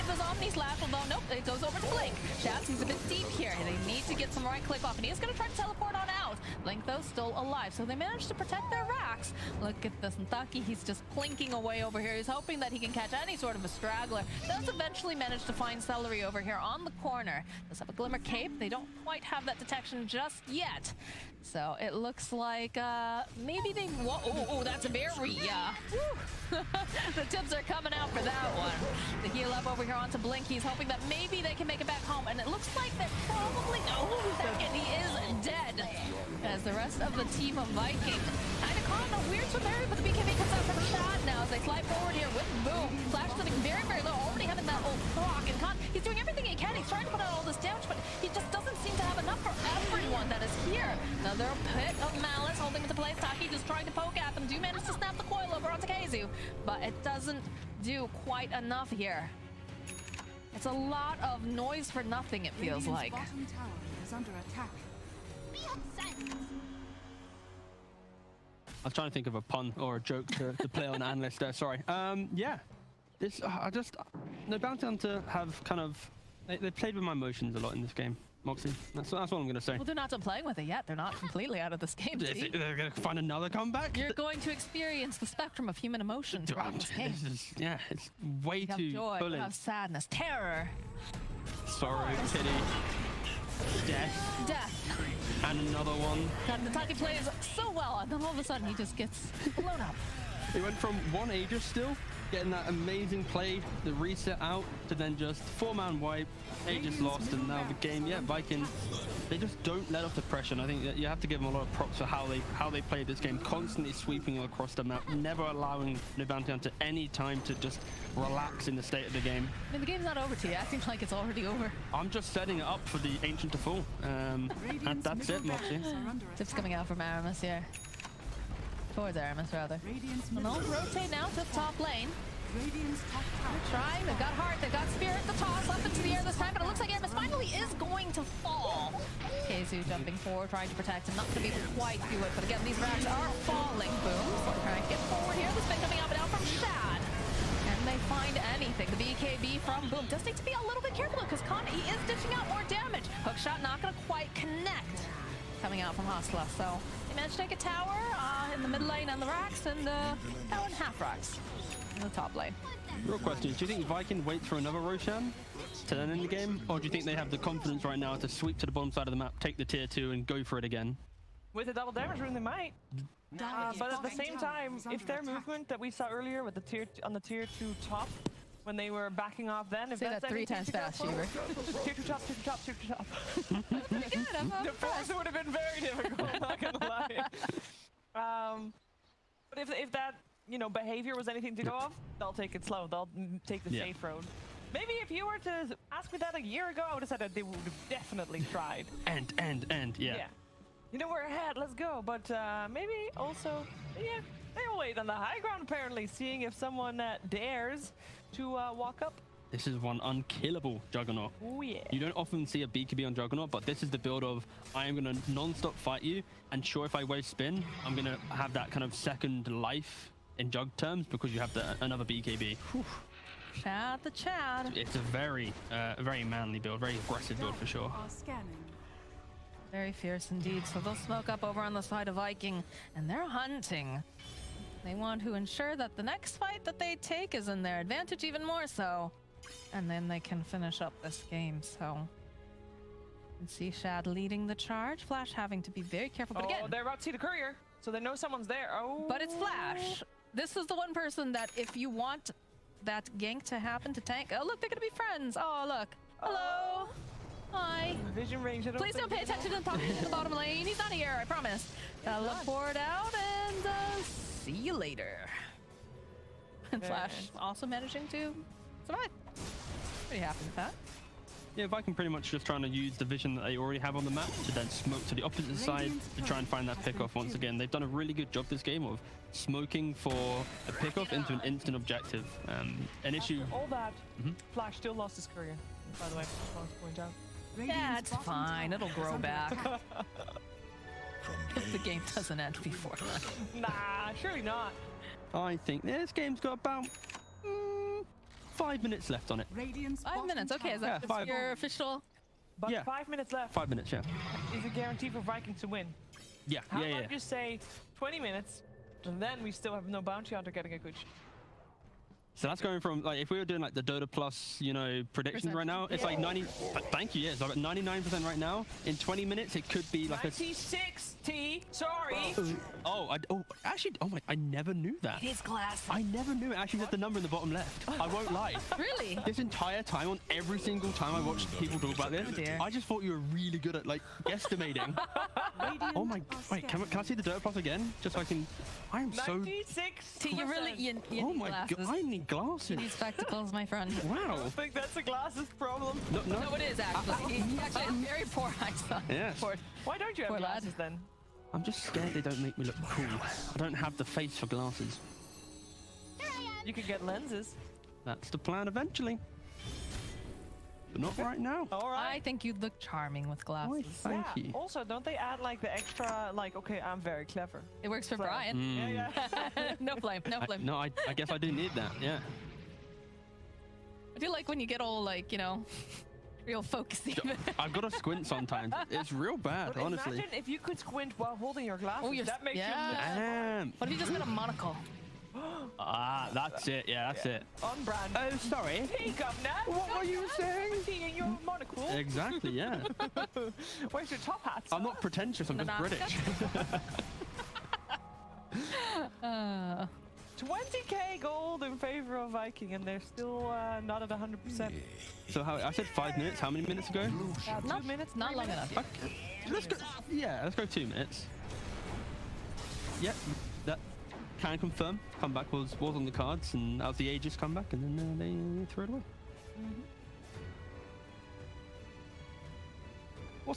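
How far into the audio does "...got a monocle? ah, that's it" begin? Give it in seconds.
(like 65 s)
384 s.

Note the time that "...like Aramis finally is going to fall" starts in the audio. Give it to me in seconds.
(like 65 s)
136 s.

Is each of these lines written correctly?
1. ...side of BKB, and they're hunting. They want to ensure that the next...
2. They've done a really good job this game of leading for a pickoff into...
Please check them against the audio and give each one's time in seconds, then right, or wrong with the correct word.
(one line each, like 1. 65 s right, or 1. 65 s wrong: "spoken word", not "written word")
1. 231 s wrong: "Viking", not "BKB"
2. 277 s wrong: "smoking", not "leading".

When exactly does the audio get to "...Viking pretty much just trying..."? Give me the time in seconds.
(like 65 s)
271 s.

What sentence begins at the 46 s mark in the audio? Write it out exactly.
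He's trying to put out all this damage, but he just doesn't seem to have enough for everyone that is here.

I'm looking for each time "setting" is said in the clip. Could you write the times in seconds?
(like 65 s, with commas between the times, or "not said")
122 s.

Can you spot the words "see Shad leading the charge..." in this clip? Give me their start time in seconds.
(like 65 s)
243 s.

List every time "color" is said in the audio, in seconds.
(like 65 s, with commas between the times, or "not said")
not said.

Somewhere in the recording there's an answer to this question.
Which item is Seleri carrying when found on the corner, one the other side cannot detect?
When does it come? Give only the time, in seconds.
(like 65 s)
17 s.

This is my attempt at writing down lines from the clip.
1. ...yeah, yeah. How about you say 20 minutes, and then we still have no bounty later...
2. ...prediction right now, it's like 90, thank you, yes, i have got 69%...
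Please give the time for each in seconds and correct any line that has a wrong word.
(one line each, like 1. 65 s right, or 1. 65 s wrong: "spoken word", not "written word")
1. 306 s wrong: "hunter", not "later"
2. 315 s wrong: "99", not "69".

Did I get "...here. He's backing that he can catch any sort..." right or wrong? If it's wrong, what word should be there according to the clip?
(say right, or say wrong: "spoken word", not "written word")
wrong: "hoping", not "backing".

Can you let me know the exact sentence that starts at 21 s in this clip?
So it looks like uh, maybe they.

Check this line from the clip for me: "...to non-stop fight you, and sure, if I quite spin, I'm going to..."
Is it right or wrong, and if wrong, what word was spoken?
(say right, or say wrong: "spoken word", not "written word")
wrong: "waste", not "quite".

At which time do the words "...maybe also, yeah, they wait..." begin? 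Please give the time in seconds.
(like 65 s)
202 s.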